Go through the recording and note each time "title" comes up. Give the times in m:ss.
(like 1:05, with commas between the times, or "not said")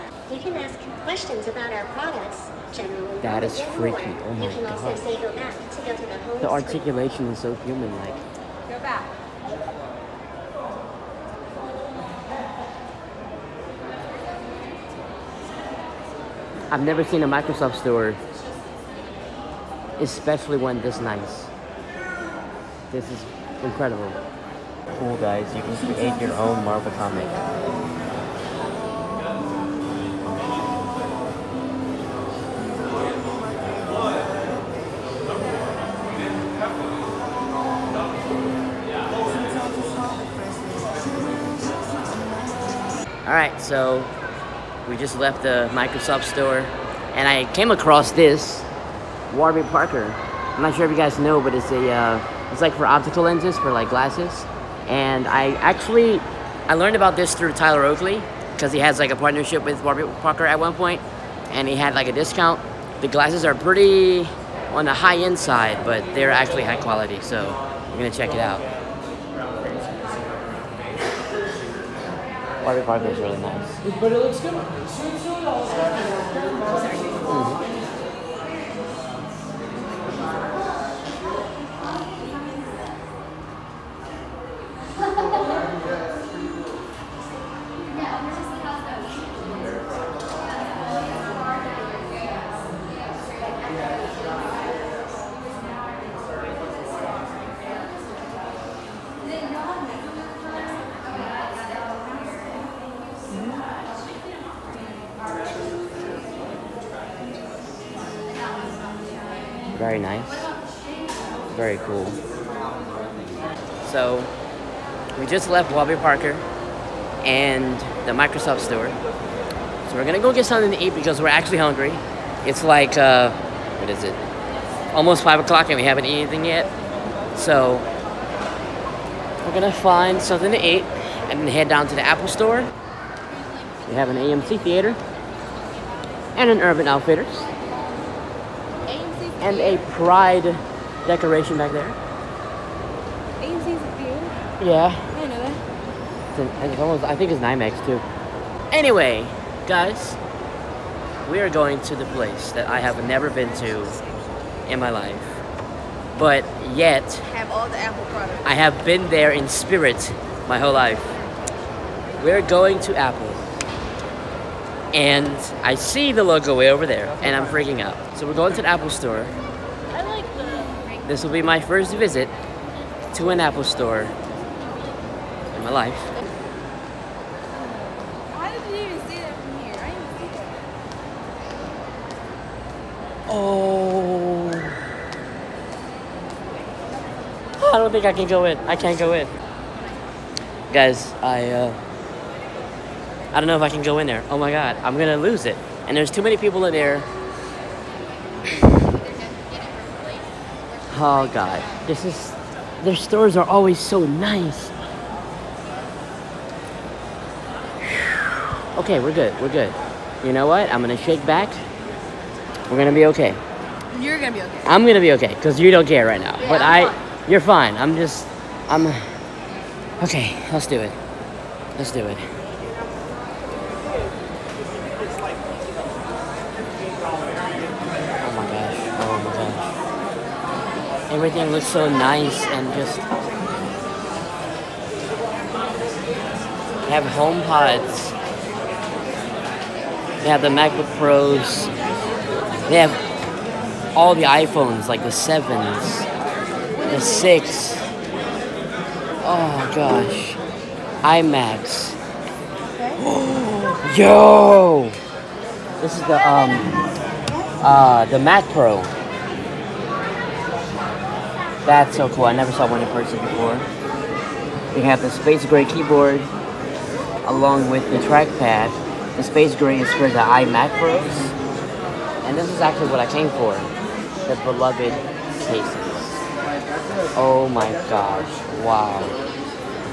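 not said.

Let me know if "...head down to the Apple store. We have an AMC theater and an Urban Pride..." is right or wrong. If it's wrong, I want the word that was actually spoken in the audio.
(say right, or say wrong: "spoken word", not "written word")
wrong: "Outfitters", not "Pride".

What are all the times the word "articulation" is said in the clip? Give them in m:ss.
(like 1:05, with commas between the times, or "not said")
0:06.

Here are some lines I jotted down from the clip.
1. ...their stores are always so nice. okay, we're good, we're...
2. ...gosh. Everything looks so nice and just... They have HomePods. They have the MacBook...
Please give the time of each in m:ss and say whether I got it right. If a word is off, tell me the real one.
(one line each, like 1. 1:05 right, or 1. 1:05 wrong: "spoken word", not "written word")
1. 3:22 right
2. 3:51 right.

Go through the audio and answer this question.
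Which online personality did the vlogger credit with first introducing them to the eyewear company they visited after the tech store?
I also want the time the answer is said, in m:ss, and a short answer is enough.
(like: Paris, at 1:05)
Tyler Oakley, at 0:57.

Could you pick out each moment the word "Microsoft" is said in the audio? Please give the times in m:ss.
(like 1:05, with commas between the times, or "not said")
0:17, 0:45, 1:58.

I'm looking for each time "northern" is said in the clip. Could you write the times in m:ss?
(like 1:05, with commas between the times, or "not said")
not said.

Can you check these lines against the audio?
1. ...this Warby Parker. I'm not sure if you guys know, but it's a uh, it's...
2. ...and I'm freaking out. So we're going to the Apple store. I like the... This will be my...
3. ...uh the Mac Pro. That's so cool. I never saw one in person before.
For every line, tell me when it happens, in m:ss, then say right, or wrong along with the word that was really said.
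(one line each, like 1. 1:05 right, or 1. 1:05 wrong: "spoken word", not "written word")
1. 0:48 right
2. 2:47 right
3. 4:17 right.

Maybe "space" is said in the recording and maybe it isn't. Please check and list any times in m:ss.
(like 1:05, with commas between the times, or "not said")
4:25, 4:29.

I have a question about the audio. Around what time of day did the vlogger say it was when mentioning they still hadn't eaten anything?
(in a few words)
almost 5 o'clock.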